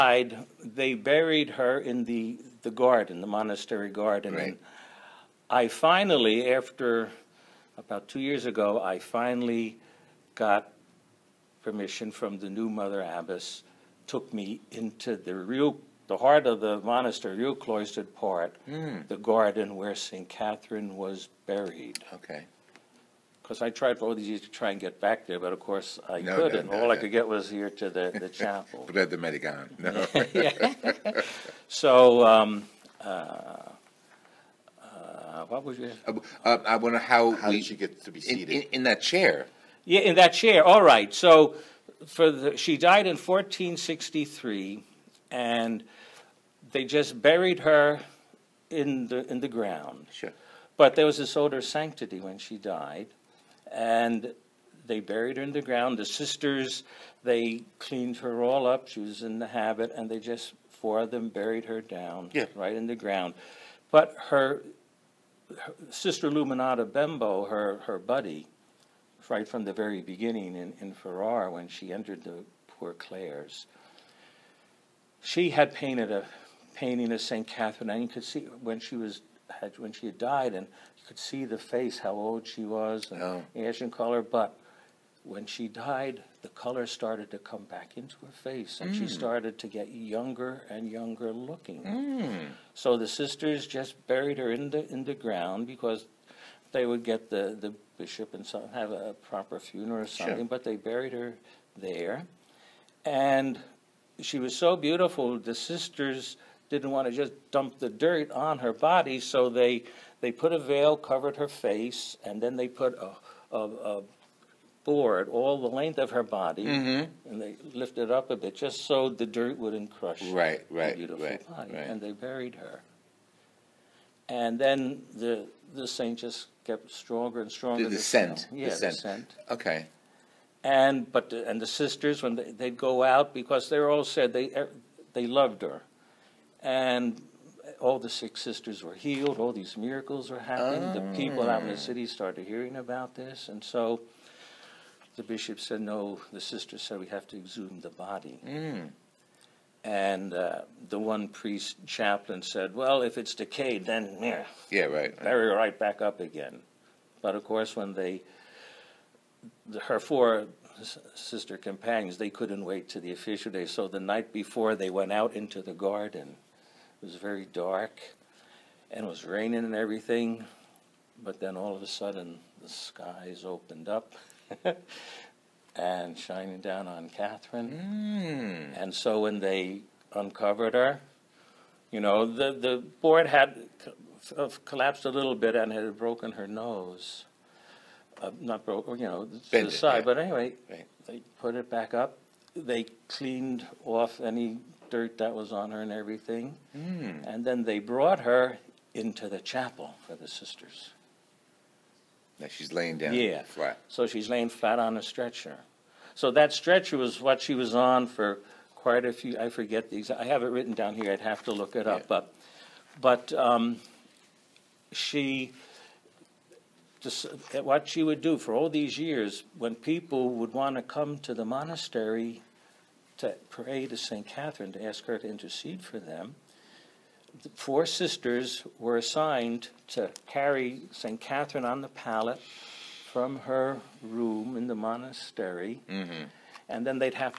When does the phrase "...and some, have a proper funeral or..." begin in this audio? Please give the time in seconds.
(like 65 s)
98 s.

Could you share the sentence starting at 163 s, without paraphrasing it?
So the night before, they went out into the garden.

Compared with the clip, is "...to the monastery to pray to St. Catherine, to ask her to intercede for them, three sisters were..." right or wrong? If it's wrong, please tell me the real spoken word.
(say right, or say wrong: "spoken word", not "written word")
wrong: "four", not "three".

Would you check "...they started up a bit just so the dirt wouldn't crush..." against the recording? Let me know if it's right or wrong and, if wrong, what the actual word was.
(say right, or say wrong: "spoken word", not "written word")
wrong: "lifted", not "started".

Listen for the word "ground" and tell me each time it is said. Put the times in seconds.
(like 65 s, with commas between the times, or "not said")
49 s, 55 s, 62 s, 95 s.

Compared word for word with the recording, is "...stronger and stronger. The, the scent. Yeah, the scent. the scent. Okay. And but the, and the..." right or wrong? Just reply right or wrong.
right.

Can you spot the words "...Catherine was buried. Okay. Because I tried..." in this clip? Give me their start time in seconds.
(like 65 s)
20 s.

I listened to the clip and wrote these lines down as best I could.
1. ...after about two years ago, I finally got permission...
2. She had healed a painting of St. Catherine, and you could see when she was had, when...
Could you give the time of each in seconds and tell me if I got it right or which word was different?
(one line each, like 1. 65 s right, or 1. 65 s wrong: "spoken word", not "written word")
1. 6 s right
2. 75 s wrong: "painted", not "healed".